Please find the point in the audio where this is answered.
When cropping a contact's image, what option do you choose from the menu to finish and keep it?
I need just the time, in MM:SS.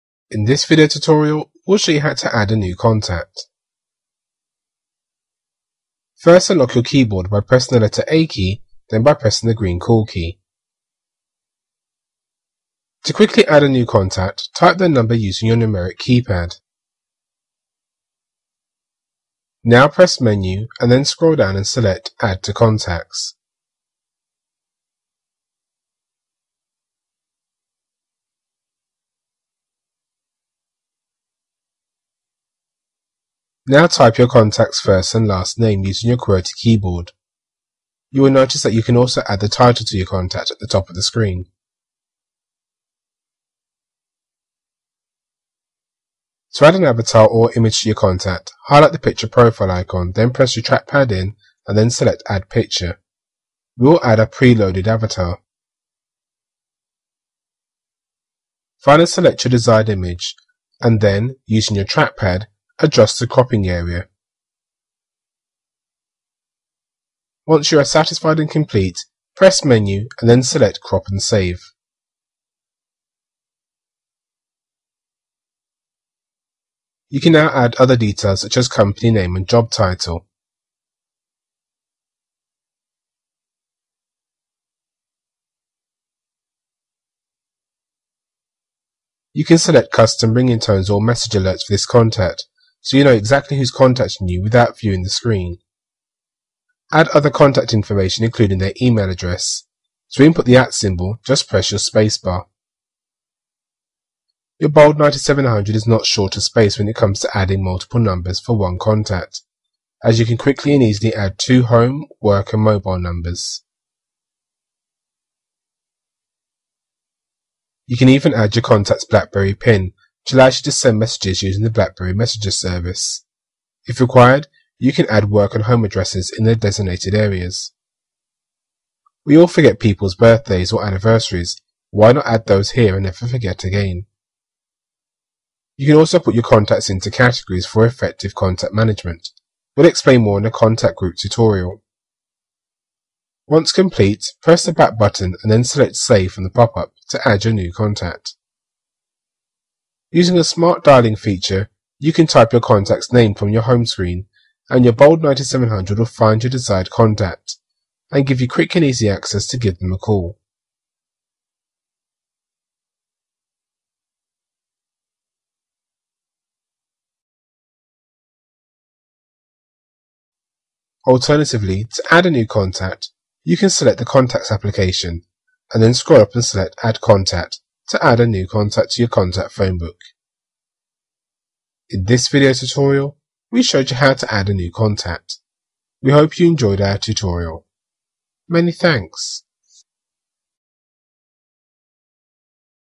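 01:10.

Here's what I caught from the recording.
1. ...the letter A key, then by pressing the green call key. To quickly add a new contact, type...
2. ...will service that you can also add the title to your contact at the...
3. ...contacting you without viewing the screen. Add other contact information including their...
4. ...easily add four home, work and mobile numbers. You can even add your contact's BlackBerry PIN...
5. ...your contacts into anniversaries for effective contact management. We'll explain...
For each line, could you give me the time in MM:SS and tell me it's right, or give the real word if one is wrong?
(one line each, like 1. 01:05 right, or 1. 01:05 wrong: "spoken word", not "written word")
1. 00:07 right
2. 00:38 wrong: "notice", not "service"
3. 01:33 right
4. 01:50 wrong: "two", not "four"
5. 02:16 wrong: "categories", not "anniversaries".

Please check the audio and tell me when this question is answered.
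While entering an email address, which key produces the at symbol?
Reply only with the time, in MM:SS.
01:41.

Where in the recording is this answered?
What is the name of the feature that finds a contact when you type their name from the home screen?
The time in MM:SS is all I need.
02:30.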